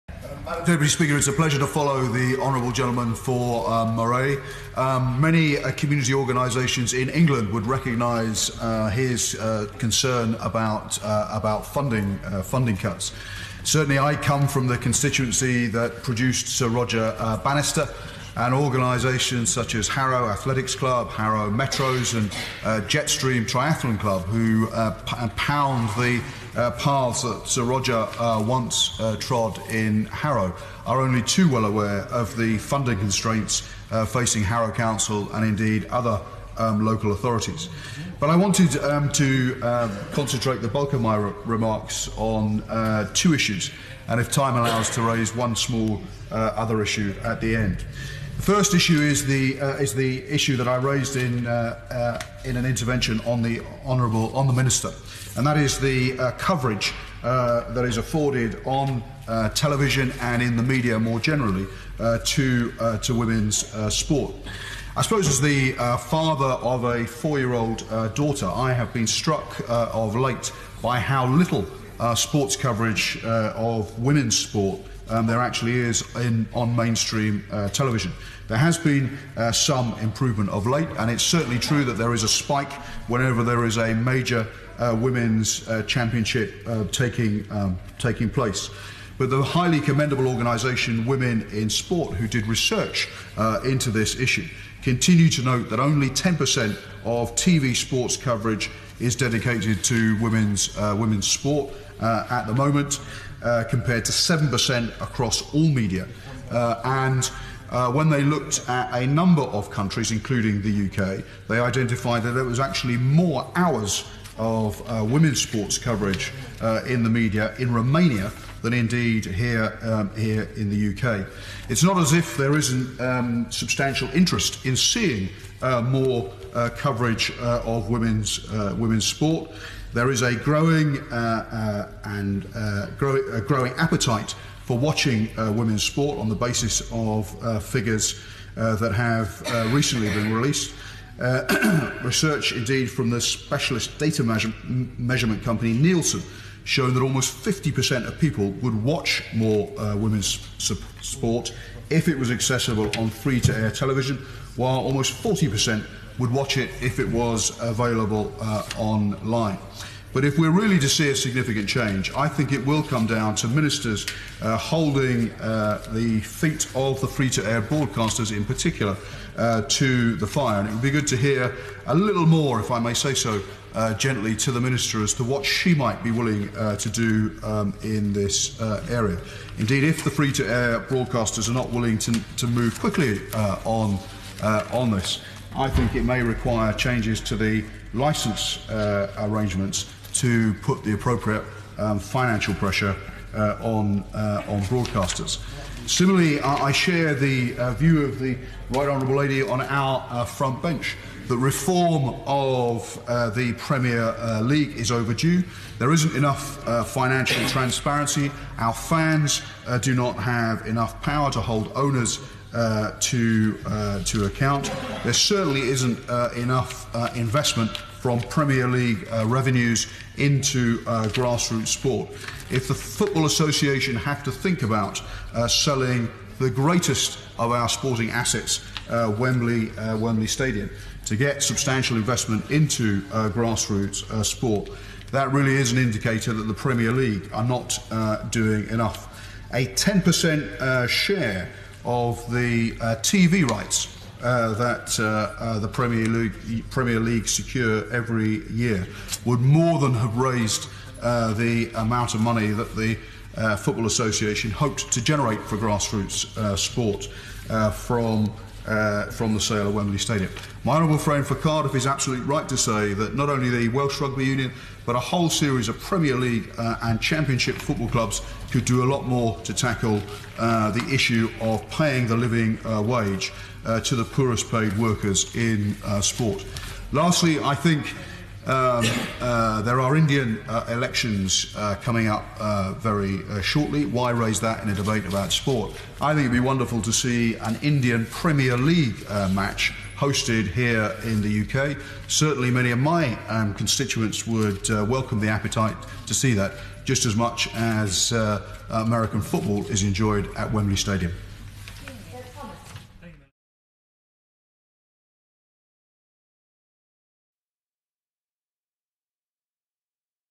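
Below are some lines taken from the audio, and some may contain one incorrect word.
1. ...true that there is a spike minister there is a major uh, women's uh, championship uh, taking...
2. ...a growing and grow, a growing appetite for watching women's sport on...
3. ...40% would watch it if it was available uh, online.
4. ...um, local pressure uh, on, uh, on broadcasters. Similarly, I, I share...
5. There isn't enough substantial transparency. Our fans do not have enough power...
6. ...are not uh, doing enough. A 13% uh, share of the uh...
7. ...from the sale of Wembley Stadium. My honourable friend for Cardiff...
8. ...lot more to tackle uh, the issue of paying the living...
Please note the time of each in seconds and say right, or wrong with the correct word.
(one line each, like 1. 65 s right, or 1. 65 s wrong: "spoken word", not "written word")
1. 81 s wrong: "whenever", not "minister"
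2. 130 s right
3. 155 s right
4. 191 s wrong: "financial", not "local"
5. 205 s wrong: "financial", not "substantial"
6. 237 s wrong: "10", not "13"
7. 259 s right
8. 268 s right.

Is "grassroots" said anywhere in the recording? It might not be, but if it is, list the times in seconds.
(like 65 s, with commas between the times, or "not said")
221 s, 233 s, 255 s.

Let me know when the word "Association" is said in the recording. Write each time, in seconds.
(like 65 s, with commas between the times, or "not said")
223 s, 253 s.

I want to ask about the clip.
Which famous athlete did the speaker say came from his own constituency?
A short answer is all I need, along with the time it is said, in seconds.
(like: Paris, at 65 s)
Sir Roger Bannister, at 16 s.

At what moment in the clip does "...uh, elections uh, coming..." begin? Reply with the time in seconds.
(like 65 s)
280 s.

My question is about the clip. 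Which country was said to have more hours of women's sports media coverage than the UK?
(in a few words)
Romania.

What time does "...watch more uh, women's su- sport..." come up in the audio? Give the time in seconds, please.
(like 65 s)
148 s.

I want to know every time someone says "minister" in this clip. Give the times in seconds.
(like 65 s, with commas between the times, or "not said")
54 s, 163 s, 174 s.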